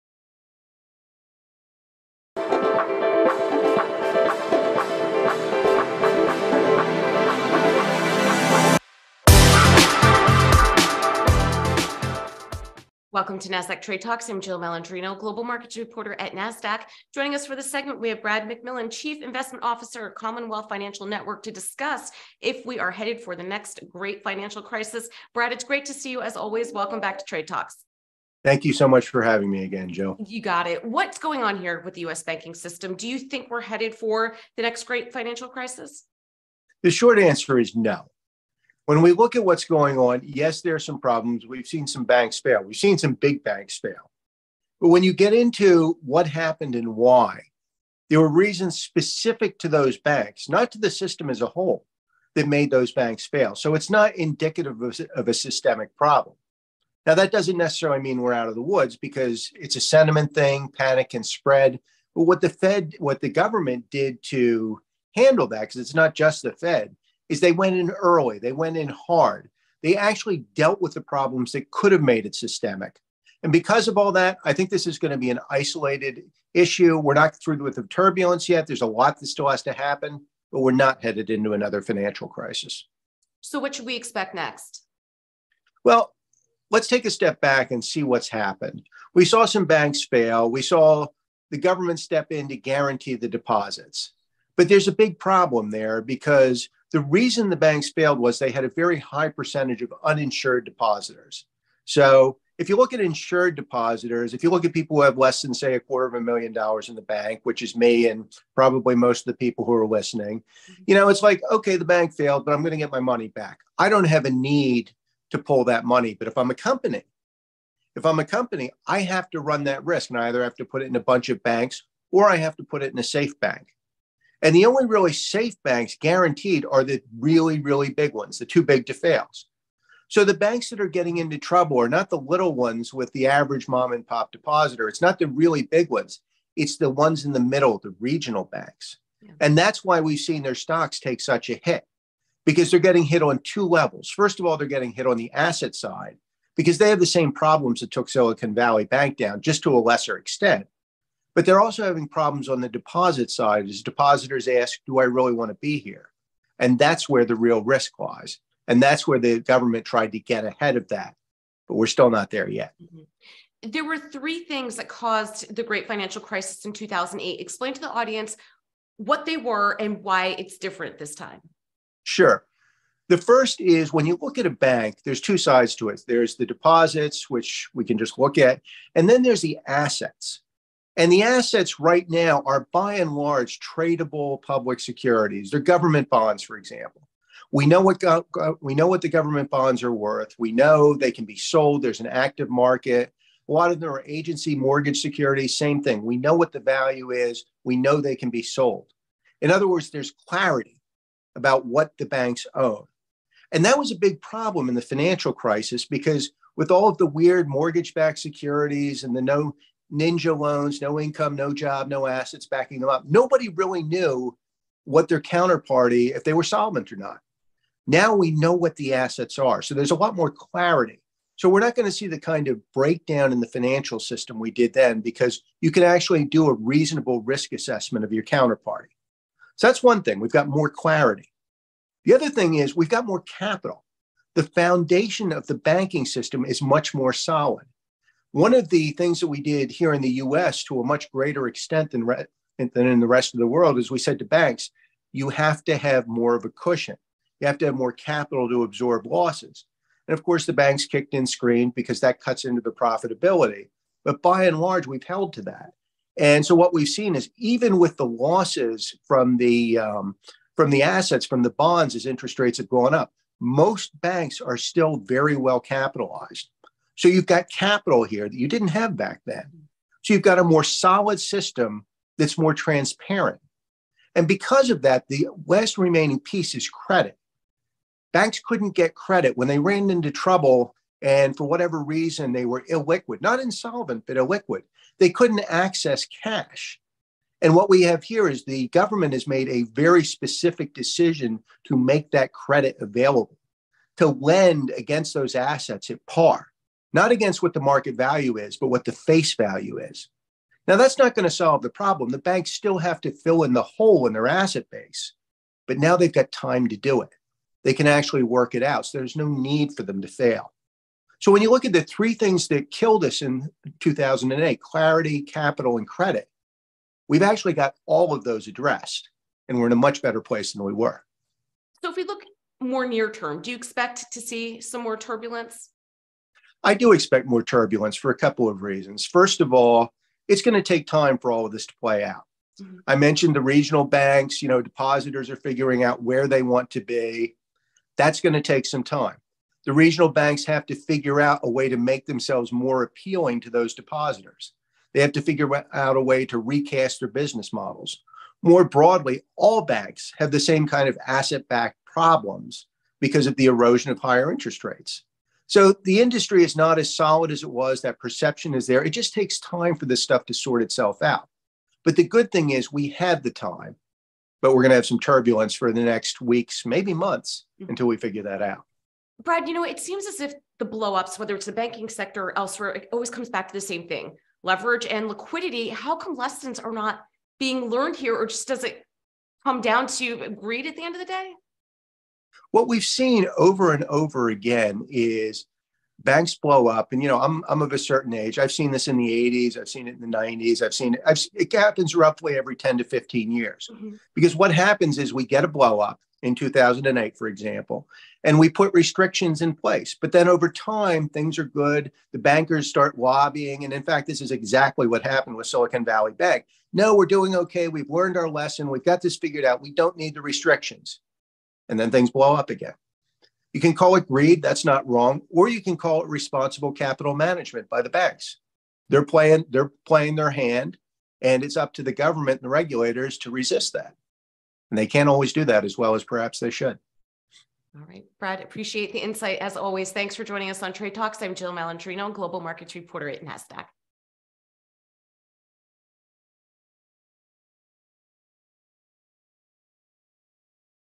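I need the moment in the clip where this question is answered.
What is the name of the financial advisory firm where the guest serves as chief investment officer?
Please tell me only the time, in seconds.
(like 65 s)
20 s.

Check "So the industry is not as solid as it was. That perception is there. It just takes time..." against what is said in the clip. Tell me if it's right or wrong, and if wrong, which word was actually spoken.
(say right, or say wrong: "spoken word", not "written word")
right.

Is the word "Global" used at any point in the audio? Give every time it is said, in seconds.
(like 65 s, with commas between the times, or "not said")
15 s, 432 s.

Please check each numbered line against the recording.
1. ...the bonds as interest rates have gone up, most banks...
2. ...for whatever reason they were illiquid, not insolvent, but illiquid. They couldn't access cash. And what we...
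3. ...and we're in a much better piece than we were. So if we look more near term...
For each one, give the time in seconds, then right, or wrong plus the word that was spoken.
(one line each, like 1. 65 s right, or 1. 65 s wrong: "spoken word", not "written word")
1. 261 s right
2. 281 s right
3. 319 s wrong: "place", not "piece".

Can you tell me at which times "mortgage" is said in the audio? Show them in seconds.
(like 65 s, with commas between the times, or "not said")
194 s, 207 s.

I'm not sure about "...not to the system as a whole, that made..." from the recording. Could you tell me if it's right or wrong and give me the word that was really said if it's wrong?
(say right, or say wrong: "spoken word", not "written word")
right.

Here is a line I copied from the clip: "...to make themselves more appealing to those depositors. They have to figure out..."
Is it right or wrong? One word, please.
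right.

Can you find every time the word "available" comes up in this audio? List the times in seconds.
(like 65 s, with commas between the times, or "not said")
292 s.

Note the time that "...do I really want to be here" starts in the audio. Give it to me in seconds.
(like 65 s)
154 s.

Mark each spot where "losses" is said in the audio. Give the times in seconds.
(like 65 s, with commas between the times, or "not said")
249 s, 258 s.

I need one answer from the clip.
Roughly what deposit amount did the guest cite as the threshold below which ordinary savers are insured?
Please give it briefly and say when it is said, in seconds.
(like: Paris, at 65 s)
a quarter of a million dollars, at 105 s.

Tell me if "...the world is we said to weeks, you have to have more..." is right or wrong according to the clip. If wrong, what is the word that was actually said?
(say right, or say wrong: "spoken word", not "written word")
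wrong: "banks", not "weeks".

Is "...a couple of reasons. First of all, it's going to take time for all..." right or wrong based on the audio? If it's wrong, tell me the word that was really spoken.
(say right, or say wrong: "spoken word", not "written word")
right.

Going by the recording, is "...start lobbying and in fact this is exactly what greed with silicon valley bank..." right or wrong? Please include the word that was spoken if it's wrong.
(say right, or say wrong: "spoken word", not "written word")
wrong: "happened", not "greed".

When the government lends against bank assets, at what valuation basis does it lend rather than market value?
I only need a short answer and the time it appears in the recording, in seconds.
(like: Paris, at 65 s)
at par, at 295 s.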